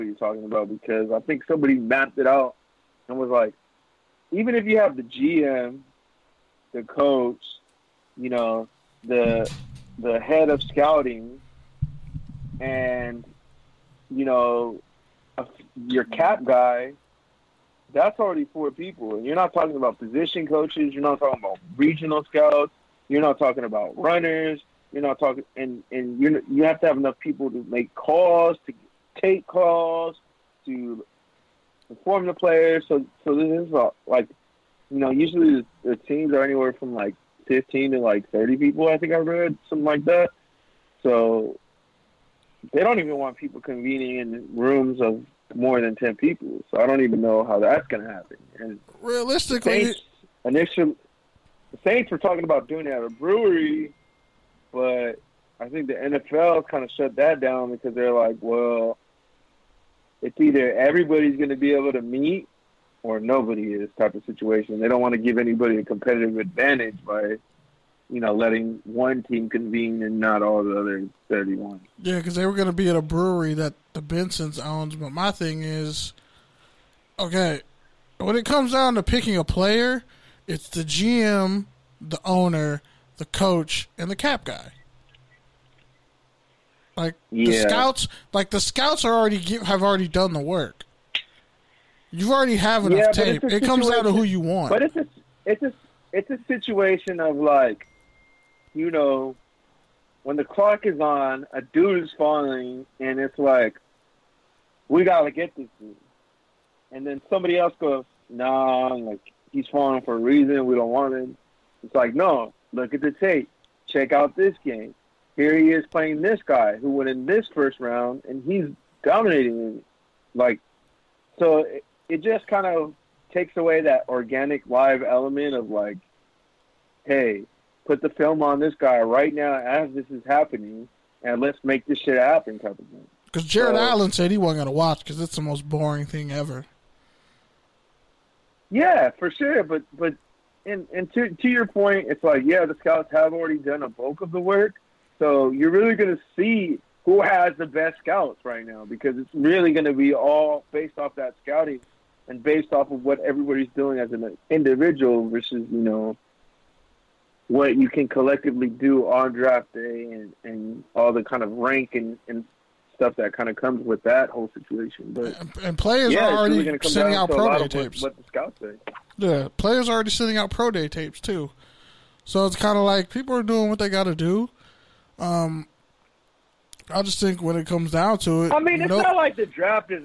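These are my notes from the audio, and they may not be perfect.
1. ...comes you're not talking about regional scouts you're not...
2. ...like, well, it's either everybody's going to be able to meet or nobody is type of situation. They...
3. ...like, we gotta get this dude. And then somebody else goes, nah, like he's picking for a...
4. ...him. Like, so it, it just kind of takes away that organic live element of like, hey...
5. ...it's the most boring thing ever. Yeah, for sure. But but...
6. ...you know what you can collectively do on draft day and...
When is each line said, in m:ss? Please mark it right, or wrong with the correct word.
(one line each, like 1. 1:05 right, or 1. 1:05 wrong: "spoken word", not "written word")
1. 0:20 wrong: "coaches", not "comes"
2. 0:58 right
3. 1:43 wrong: "falling", not "picking"
4. 1:59 right
5. 2:15 right
6. 2:35 right.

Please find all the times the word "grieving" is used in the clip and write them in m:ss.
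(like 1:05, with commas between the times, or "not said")
not said.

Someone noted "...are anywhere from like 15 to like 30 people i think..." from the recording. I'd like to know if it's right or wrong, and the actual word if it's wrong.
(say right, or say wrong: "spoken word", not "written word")
right.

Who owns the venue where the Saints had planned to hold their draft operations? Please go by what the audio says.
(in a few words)
The Bensons.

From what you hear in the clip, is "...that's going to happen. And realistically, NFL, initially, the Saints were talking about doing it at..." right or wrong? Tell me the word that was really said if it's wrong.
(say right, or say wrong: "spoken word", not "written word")
wrong: "Saints", not "NFL".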